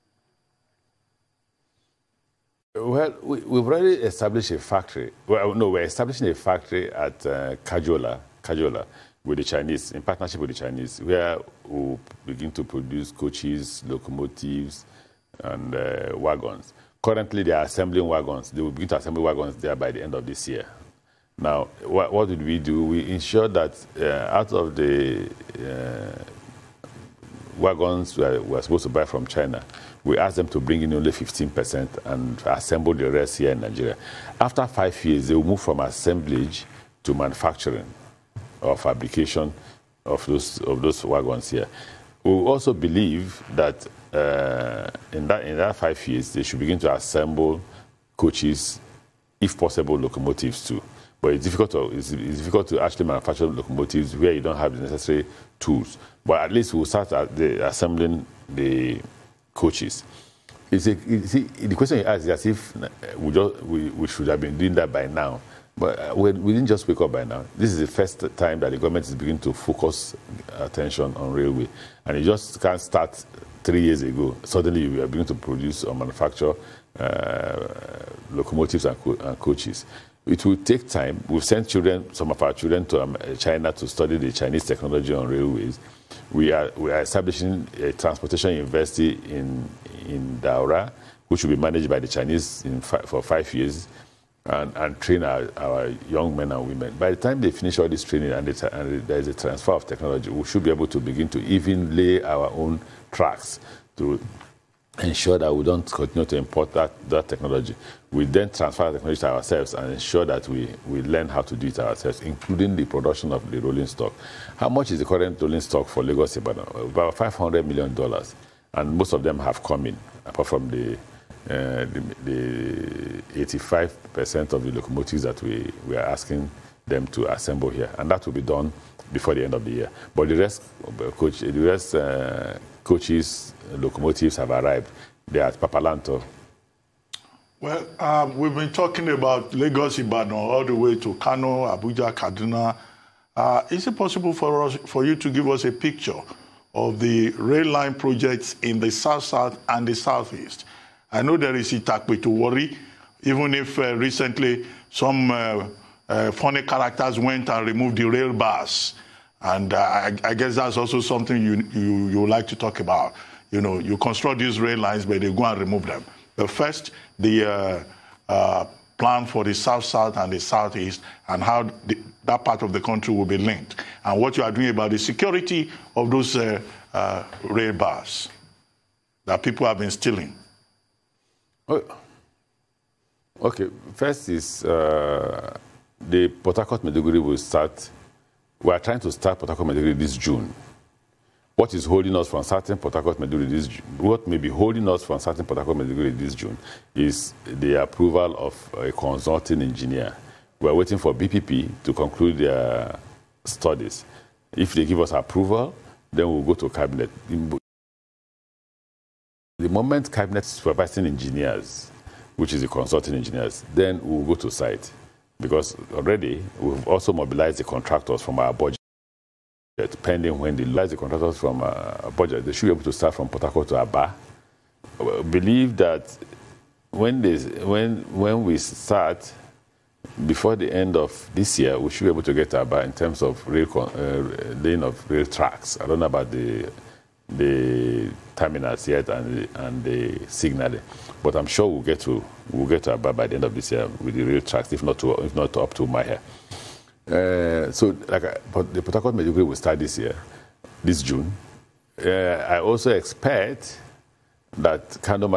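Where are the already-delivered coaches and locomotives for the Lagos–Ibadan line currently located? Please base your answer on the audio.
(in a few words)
Papalanto.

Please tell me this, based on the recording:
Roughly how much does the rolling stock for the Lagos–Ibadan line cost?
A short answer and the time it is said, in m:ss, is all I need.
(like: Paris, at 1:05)
$500 million, at 1:57.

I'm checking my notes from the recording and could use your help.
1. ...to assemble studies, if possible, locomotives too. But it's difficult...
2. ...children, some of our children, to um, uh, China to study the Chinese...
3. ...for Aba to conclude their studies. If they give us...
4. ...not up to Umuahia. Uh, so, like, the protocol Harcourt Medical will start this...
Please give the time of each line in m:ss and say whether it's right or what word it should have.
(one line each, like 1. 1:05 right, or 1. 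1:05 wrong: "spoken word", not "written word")
1. 0:46 wrong: "coaches", not "studies"
2. 1:21 right
3. 3:20 wrong: "BPP", not "Aba"
4. 4:05 right.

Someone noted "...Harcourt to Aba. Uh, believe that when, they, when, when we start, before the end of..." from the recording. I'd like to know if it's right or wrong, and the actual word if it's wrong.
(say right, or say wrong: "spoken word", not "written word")
right.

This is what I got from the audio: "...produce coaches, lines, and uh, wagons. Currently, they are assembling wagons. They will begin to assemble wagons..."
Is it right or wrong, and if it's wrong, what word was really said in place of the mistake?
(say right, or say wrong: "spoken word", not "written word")
wrong: "locomotives", not "lines".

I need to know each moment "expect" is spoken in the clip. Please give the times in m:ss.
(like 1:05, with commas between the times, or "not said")
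4:12.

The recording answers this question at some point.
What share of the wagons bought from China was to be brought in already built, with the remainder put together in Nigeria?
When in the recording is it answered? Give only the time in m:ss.
0:31.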